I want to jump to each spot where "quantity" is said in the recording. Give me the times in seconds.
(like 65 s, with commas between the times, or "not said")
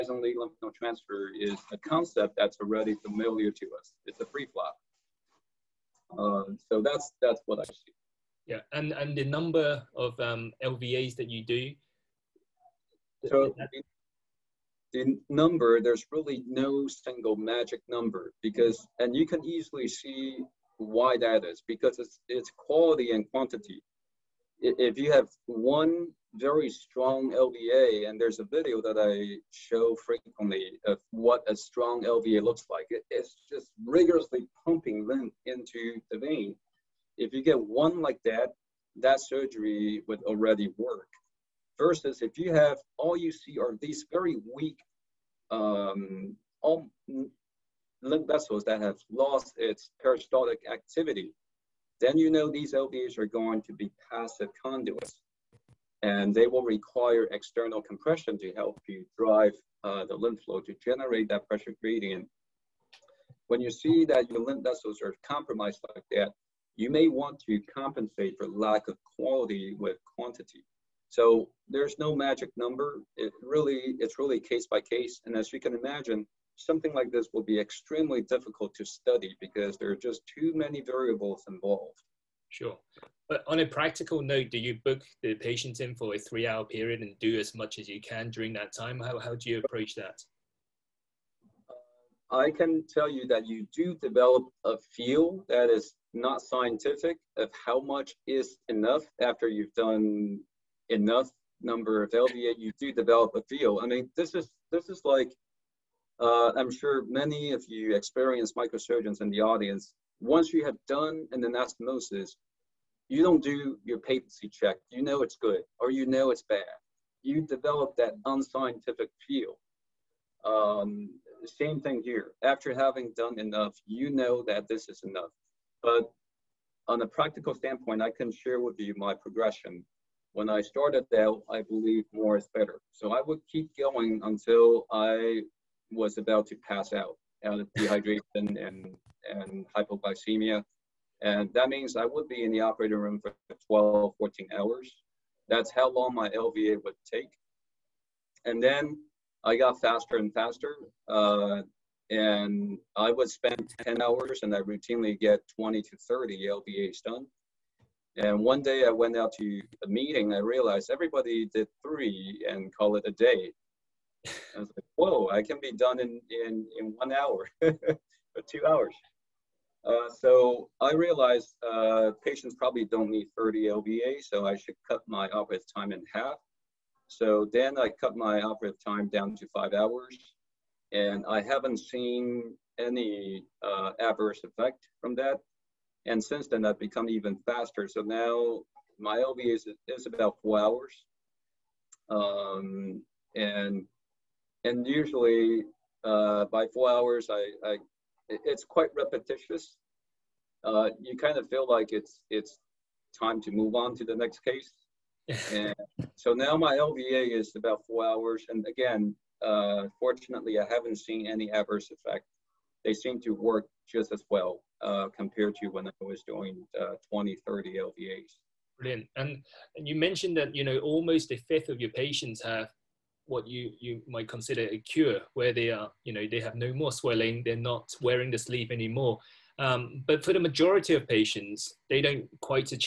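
23 s, 70 s.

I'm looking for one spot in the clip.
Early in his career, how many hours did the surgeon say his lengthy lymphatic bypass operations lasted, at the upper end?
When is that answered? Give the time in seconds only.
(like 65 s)
144 s.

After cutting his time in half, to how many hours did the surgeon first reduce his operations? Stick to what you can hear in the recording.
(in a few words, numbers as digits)
5.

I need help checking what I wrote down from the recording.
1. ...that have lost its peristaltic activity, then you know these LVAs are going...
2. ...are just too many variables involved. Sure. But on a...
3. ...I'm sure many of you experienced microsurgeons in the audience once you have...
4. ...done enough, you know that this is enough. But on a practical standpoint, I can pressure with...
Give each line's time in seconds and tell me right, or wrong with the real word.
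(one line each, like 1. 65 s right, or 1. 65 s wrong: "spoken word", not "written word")
1. 48 s right
2. 79 s right
3. 106 s right
4. 123 s wrong: "share", not "pressure".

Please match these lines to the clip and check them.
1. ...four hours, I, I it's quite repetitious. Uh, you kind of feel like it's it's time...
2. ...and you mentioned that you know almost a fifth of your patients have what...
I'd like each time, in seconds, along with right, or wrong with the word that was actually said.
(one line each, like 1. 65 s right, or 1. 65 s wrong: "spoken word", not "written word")
1. 196 s right
2. 219 s right.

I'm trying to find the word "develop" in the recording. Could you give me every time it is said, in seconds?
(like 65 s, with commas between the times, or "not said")
93 s, 102 s, 117 s.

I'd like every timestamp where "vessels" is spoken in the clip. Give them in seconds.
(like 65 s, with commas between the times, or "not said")
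48 s, 64 s.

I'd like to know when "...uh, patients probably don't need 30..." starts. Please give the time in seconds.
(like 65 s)
171 s.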